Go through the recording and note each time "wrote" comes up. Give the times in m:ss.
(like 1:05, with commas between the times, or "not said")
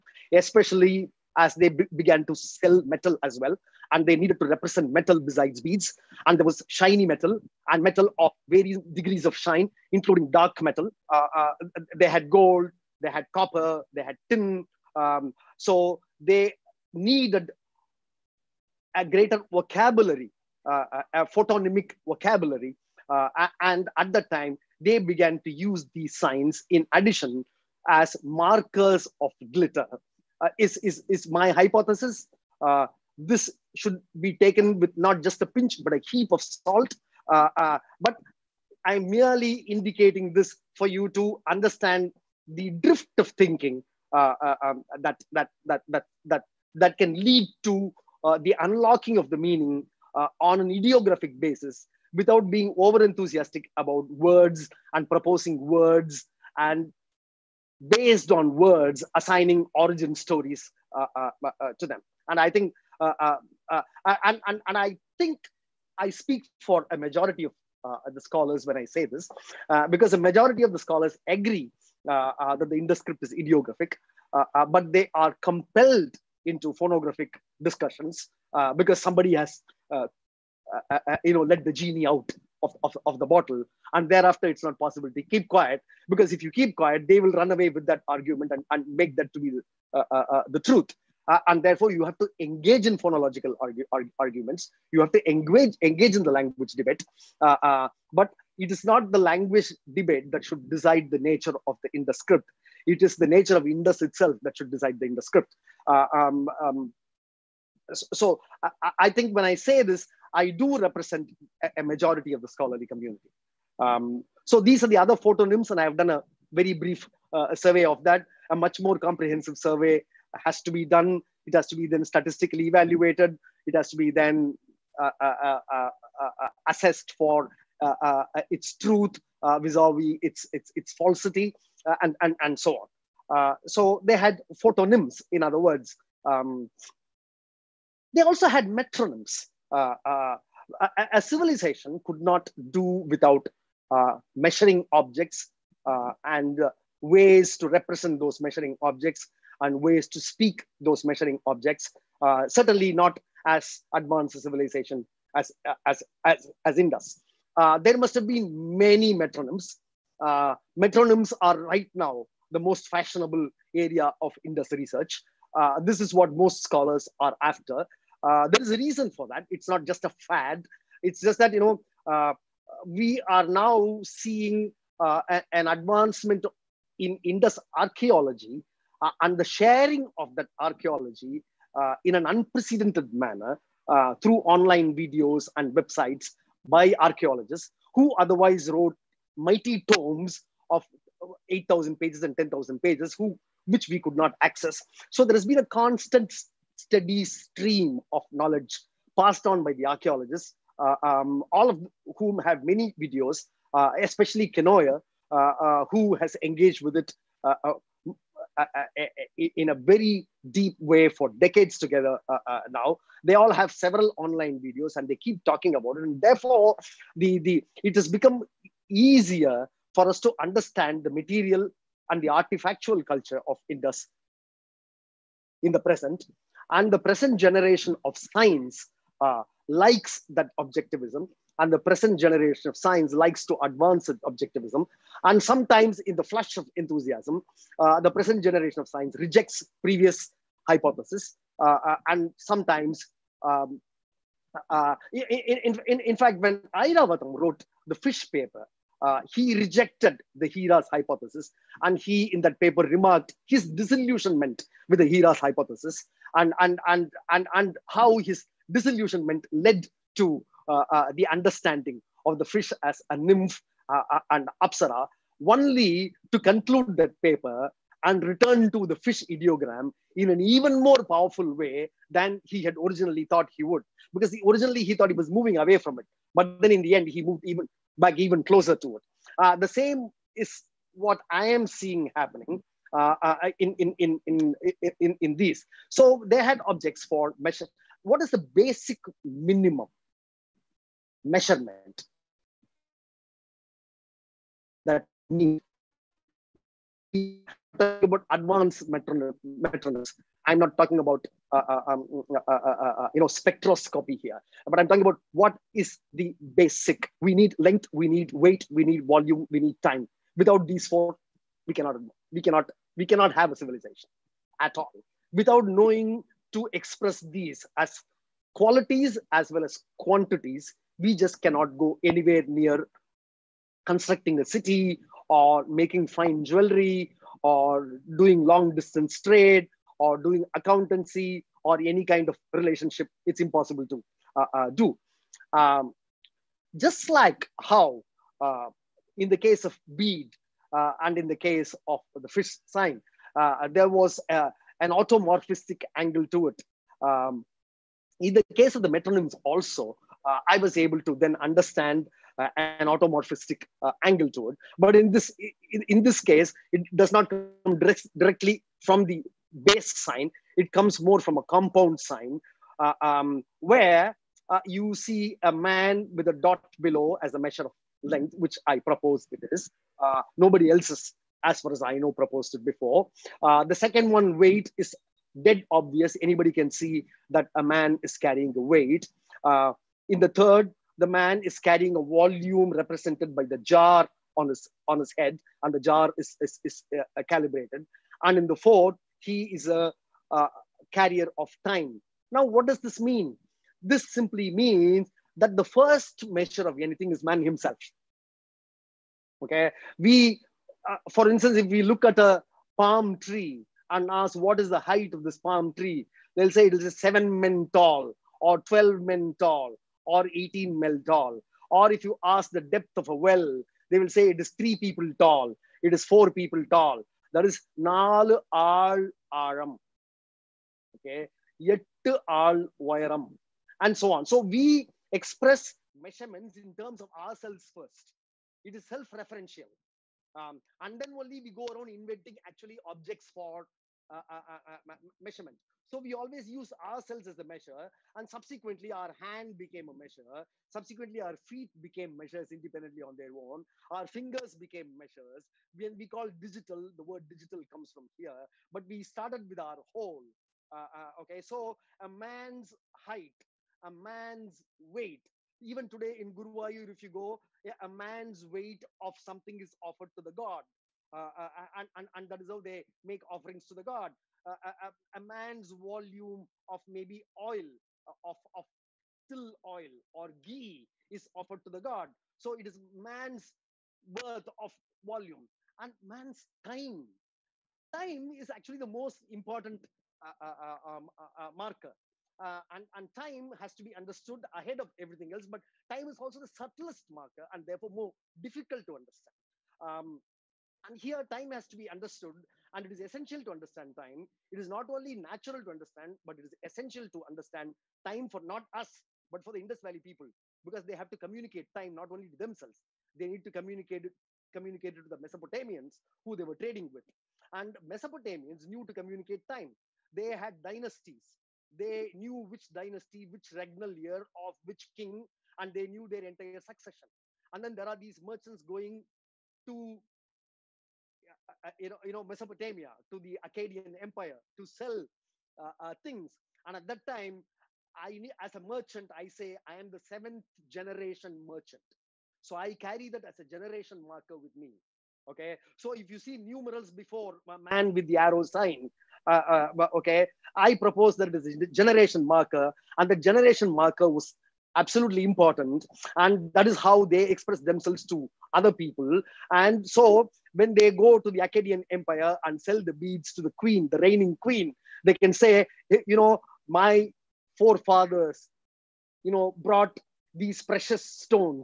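3:08, 4:07.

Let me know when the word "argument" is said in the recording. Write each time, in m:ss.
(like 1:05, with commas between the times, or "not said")
1:28, 1:34.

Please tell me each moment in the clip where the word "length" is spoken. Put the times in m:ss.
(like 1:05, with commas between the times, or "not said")
5:07, 6:08.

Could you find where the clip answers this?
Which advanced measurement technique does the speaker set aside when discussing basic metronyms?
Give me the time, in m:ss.
5:03.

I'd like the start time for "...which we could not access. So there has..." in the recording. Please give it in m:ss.
3:13.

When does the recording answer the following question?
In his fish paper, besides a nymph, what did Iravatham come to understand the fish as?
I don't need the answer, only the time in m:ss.
4:24.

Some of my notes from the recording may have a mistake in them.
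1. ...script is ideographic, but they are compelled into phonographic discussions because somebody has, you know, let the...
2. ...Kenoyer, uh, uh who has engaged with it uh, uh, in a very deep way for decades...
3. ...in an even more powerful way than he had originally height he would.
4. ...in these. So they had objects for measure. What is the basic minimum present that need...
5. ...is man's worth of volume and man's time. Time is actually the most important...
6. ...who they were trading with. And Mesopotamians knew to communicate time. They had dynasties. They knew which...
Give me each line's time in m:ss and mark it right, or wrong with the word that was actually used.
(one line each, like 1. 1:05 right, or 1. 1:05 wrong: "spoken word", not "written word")
1. 1:12 right
2. 3:24 right
3. 4:30 wrong: "thought", not "height"
4. 4:45 wrong: "measurement", not "present"
5. 7:52 right
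6. 8:26 right.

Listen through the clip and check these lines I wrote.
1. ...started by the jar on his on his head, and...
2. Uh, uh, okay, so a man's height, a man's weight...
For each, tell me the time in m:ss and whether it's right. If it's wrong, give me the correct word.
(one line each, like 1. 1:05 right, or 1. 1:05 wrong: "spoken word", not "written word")
1. 6:22 wrong: "represented", not "started"
2. 7:30 right.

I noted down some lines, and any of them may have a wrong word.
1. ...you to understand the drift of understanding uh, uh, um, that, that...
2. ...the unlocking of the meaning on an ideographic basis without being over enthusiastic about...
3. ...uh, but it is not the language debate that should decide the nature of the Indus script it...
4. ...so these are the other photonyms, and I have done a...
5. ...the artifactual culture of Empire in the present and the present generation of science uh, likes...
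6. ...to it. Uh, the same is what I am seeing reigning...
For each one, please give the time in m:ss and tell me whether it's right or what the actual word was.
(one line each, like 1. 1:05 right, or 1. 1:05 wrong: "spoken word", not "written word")
1. 0:40 wrong: "thinking", not "understanding"
2. 0:48 right
3. 1:37 right
4. 1:54 right
5. 3:42 wrong: "Indus", not "Empire"
6. 4:38 wrong: "happening", not "reigning".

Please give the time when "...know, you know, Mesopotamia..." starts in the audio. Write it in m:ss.
8:41.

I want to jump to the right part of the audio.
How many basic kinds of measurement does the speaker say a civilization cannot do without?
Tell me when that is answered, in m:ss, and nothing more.
5:10.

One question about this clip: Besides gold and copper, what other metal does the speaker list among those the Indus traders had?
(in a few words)
tin.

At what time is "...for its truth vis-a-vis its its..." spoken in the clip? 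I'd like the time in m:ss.
2:07.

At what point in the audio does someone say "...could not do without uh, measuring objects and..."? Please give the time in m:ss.
2:22.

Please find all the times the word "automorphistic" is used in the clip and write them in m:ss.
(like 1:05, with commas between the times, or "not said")
5:44, 5:52.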